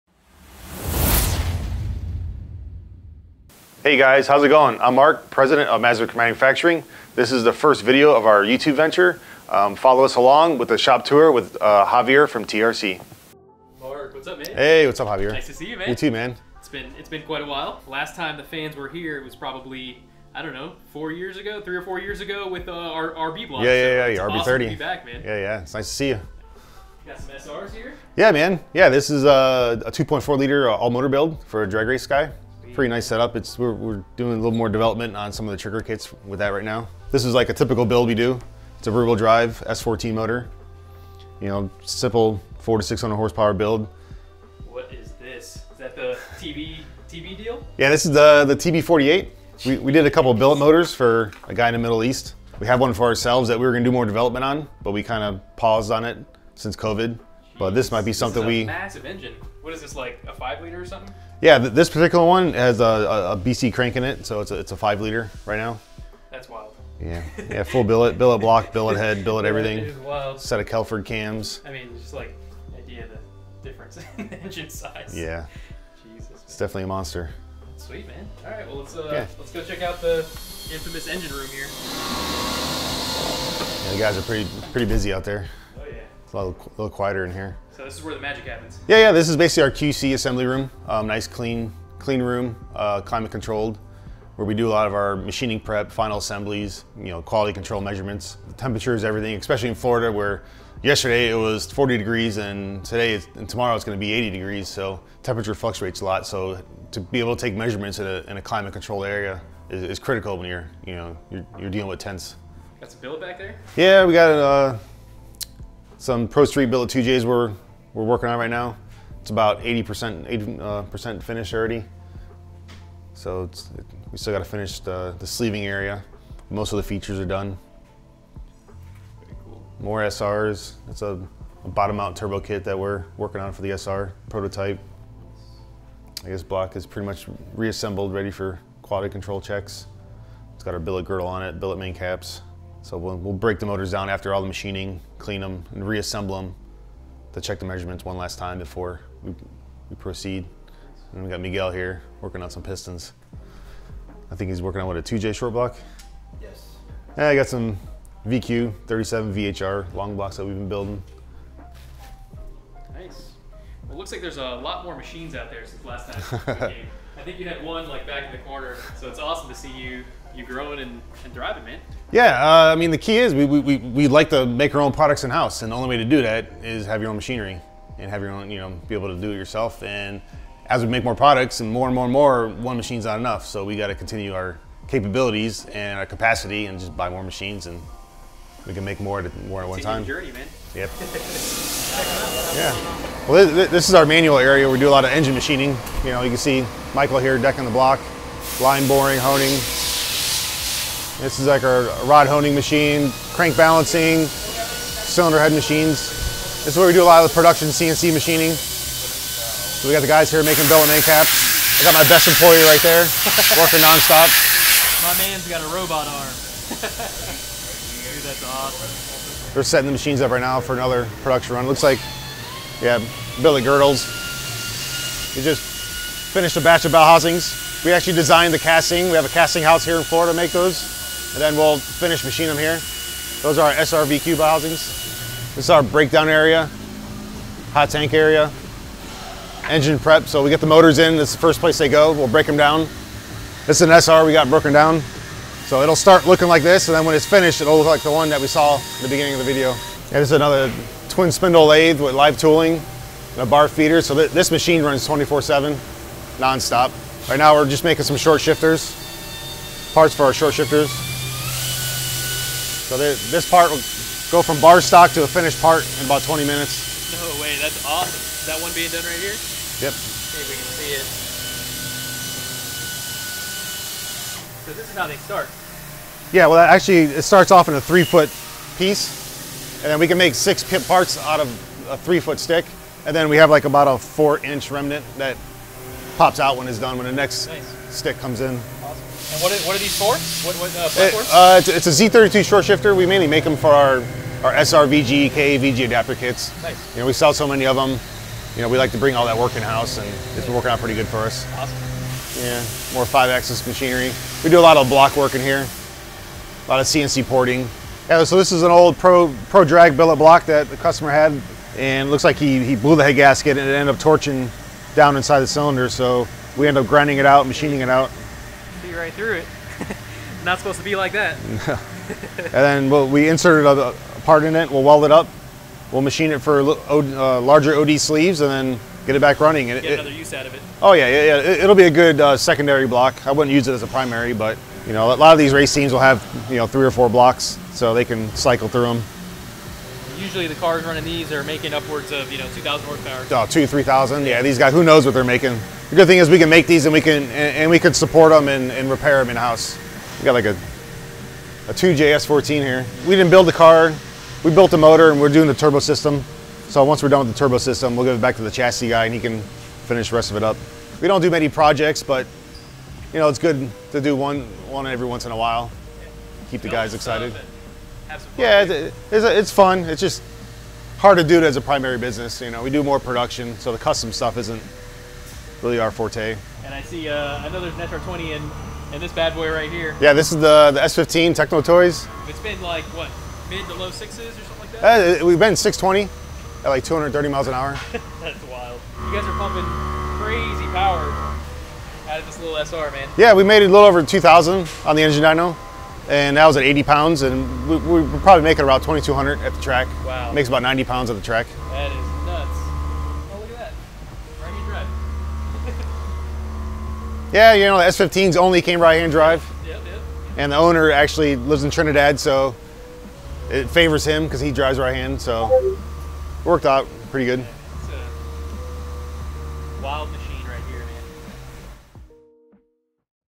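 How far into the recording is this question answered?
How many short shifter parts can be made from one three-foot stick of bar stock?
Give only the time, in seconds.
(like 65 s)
280 s.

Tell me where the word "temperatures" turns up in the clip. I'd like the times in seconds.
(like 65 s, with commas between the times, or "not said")
98 s, 105 s.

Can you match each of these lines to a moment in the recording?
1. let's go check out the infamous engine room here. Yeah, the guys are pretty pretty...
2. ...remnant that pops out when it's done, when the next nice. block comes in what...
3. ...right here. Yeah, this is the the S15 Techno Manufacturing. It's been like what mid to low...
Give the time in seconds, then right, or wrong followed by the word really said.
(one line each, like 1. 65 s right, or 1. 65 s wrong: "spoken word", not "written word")
1. 79 s right
2. 284 s wrong: "stick", not "block"
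3. 379 s wrong: "Toys", not "Manufacturing".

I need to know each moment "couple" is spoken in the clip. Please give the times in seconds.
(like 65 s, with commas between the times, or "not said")
50 s.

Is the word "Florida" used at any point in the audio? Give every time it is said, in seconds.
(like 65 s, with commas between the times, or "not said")
99 s, 230 s.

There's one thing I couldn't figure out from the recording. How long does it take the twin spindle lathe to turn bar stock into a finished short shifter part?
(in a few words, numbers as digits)
20 minutes.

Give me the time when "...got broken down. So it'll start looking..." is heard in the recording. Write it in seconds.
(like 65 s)
244 s.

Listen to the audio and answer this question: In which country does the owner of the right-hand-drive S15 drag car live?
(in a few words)
Trinidad.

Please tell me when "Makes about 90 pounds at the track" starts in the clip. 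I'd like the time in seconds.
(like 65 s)
400 s.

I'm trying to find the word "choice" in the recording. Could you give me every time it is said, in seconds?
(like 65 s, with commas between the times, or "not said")
not said.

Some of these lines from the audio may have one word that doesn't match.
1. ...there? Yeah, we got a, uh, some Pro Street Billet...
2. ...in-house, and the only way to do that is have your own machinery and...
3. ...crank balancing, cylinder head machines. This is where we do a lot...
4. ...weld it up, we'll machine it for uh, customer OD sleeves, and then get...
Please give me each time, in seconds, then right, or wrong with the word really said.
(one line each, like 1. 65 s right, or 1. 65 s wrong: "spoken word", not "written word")
1. 113 s right
2. 175 s right
3. 203 s right
4. 324 s wrong: "larger", not "customer".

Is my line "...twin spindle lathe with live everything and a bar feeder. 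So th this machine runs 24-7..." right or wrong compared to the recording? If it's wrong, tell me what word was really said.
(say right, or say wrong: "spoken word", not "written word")
wrong: "tooling", not "everything".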